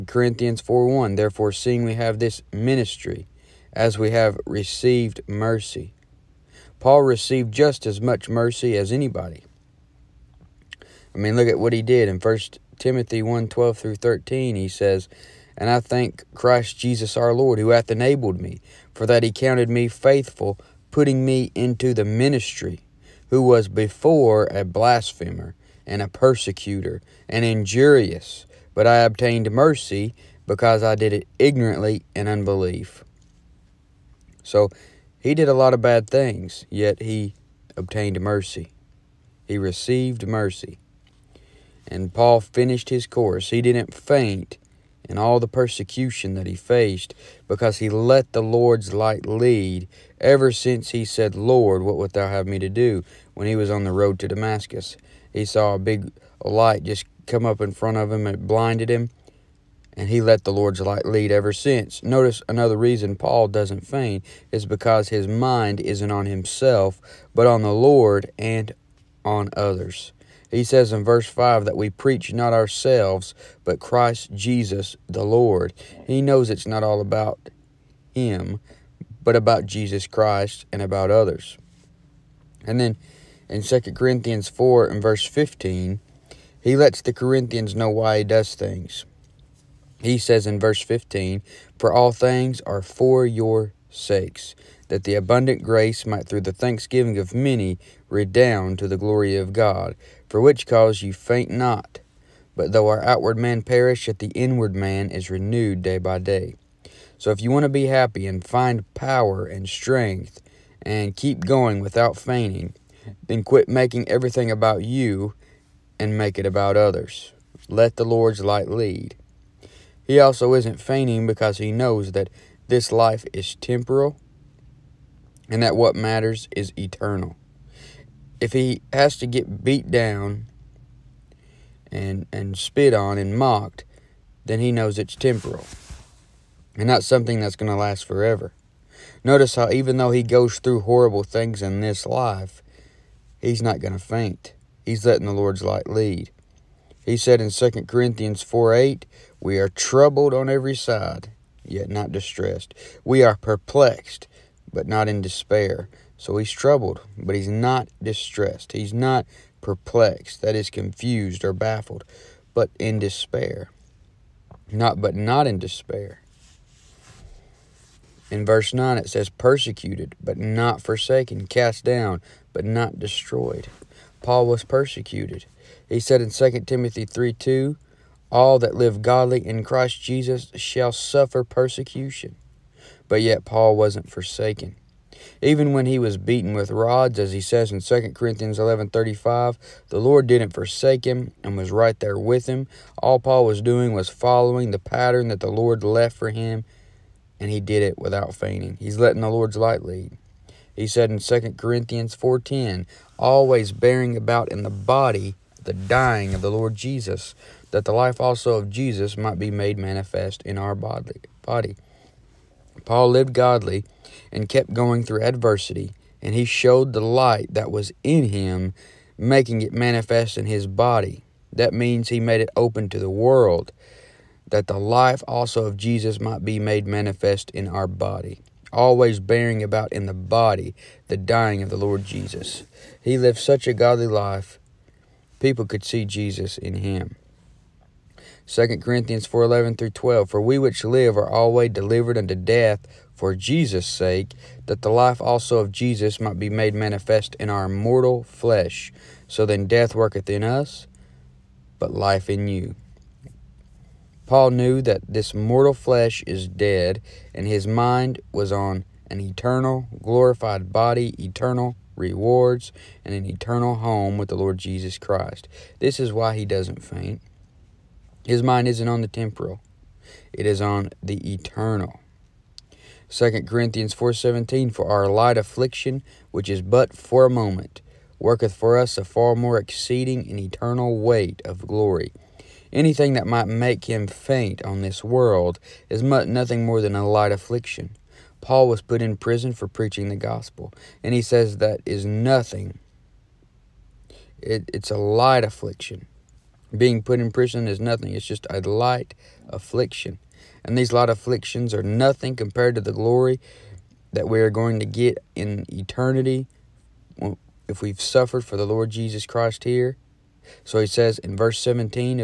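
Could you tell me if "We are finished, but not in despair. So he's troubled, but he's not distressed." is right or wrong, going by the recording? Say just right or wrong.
wrong.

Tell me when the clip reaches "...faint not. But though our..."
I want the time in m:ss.
1:41.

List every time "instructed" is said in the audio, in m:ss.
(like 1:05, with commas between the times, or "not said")
not said.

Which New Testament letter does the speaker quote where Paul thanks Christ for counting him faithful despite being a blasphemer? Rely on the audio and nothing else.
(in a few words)
First Timothy.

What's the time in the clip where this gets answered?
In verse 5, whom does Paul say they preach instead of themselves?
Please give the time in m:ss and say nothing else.
1:13.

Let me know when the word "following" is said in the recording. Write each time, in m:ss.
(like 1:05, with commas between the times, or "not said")
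3:14.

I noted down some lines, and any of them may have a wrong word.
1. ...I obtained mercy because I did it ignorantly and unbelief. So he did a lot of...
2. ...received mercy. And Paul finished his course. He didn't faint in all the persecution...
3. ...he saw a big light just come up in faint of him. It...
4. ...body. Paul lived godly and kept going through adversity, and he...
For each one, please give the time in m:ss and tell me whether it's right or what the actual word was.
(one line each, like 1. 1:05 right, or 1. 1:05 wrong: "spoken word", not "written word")
1. 0:28 right
2. 0:39 right
3. 0:55 wrong: "front", not "faint"
4. 3:30 right.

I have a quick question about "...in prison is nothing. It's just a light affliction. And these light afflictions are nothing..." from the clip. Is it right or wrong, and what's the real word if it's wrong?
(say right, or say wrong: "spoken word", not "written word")
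right.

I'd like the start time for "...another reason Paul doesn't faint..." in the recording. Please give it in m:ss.
1:02.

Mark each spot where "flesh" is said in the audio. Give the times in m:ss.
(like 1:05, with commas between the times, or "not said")
4:08, 4:15.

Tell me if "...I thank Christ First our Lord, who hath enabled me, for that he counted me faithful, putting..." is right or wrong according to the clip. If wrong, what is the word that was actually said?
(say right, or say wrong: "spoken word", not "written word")
wrong: "Jesus", not "First".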